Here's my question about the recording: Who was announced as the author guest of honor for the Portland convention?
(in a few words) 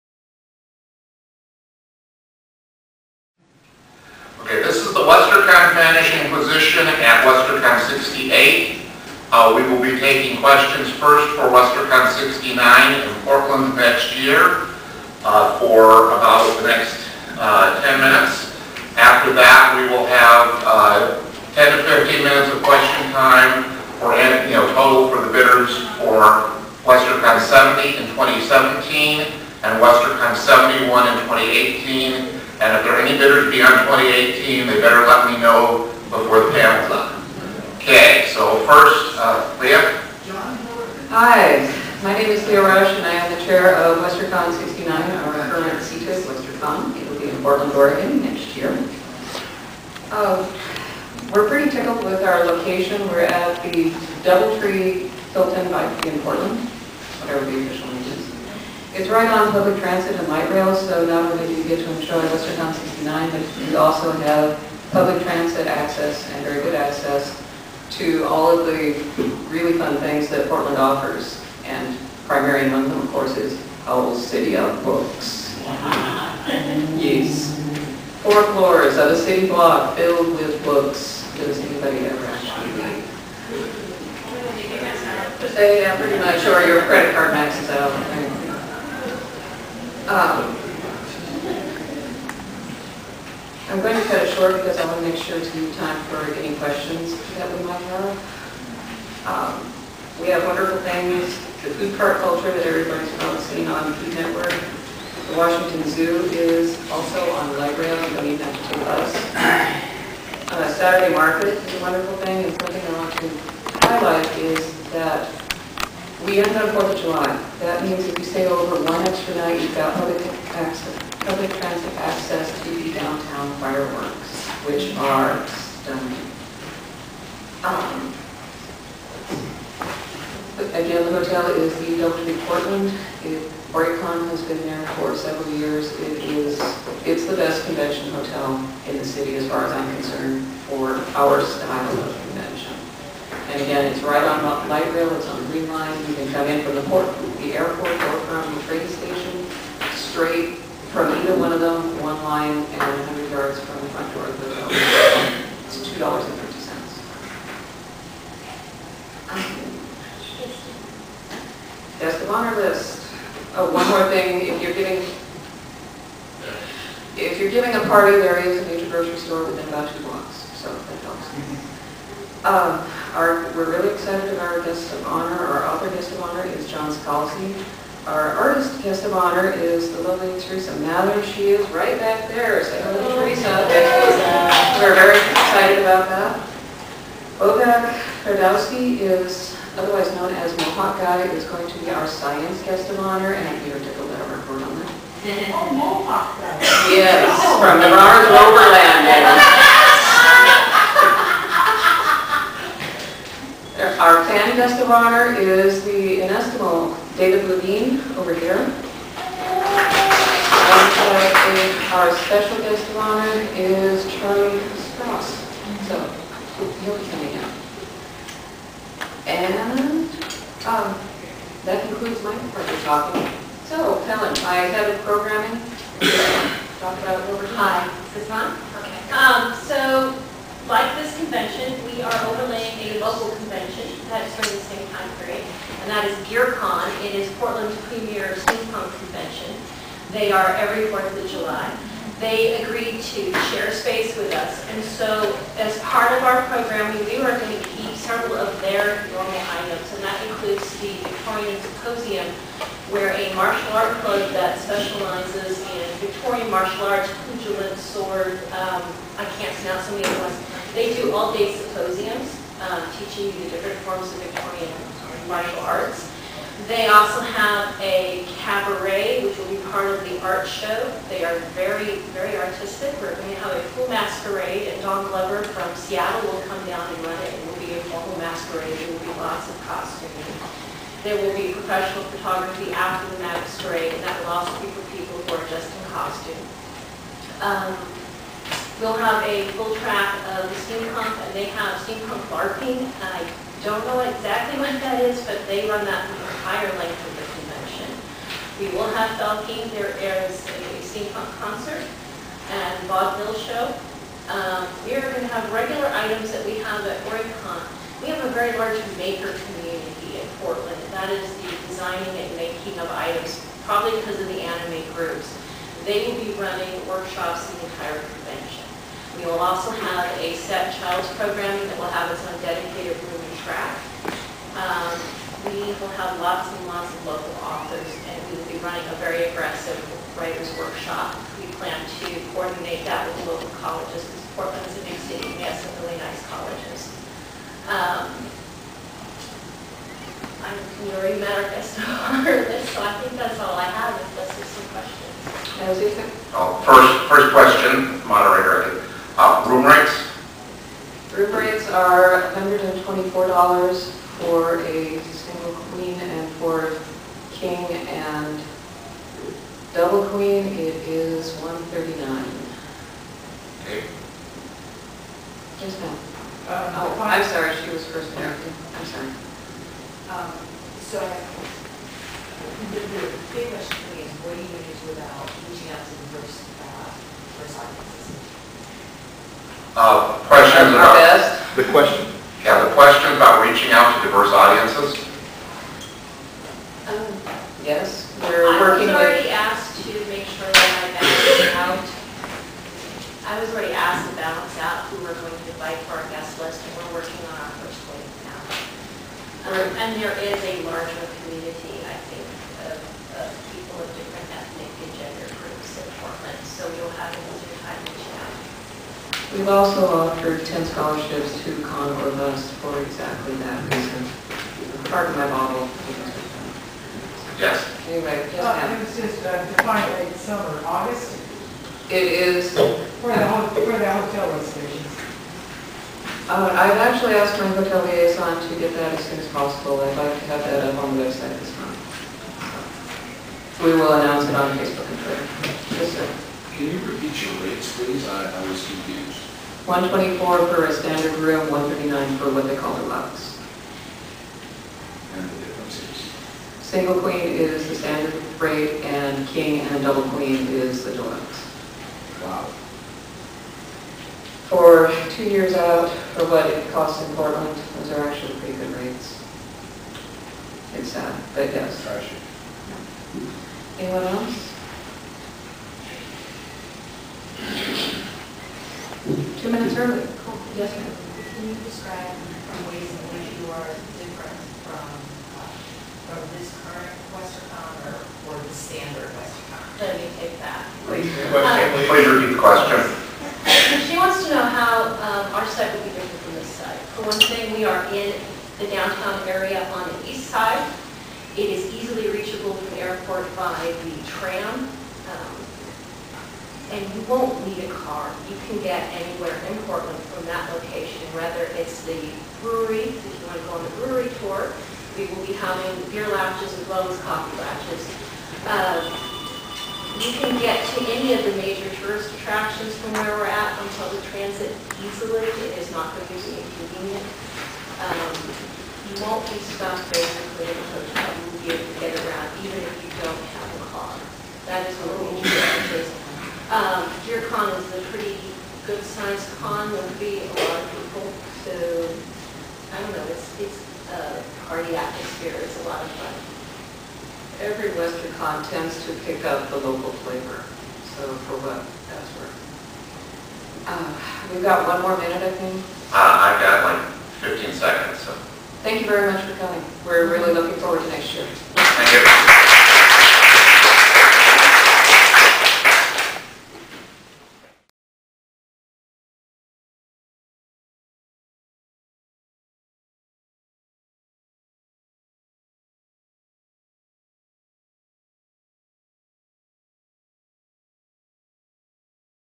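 John Scalzi.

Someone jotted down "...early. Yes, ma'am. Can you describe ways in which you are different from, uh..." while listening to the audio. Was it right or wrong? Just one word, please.
right.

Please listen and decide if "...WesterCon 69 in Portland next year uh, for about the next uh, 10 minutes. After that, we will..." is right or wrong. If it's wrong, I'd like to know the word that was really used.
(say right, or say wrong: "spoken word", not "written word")
right.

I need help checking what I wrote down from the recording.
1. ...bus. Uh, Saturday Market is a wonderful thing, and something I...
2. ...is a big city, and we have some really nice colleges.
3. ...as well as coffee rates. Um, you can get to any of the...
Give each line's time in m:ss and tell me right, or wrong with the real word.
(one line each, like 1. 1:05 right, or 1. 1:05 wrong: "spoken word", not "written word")
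1. 1:48 right
2. 5:34 right
3. 8:26 wrong: "klatches", not "rates".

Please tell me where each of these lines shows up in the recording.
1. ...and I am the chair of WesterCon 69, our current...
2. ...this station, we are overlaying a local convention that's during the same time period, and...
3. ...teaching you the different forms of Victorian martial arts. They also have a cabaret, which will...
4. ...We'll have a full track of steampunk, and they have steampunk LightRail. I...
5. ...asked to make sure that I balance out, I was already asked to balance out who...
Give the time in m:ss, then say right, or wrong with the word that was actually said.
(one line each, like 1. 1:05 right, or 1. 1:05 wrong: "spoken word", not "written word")
1. 0:43 right
2. 3:50 wrong: "convention", not "station"
3. 4:22 right
4. 4:48 wrong: "LARPing", not "LightRail"
5. 6:29 right.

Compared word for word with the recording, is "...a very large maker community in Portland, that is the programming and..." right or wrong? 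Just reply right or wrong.
wrong.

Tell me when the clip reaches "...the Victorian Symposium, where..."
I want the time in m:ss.
4:10.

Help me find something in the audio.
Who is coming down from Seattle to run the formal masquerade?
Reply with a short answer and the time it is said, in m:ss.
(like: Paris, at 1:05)
Don Glover, at 4:34.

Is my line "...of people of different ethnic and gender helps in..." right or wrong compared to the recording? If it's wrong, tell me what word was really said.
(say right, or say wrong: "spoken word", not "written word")
wrong: "groups", not "helps".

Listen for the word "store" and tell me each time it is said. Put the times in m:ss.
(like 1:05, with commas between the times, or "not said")
2:49.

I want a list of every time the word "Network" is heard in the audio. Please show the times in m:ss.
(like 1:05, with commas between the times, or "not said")
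1:44.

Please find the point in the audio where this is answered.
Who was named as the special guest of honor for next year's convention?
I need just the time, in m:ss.
3:34.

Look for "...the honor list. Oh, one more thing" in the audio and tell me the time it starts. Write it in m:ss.
2:42.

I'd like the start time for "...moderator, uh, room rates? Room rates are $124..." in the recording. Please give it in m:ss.
5:48.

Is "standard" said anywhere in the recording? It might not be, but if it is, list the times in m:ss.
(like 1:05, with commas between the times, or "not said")
7:20, 7:27, 7:58.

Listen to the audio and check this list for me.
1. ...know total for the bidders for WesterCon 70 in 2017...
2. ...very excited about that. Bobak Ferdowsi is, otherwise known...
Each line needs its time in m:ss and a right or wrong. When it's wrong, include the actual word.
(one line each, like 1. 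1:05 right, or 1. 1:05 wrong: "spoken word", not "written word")
1. 0:24 right
2. 3:04 right.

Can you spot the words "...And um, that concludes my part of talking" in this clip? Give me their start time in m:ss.
3:39.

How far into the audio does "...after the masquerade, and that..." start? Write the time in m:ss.
4:42.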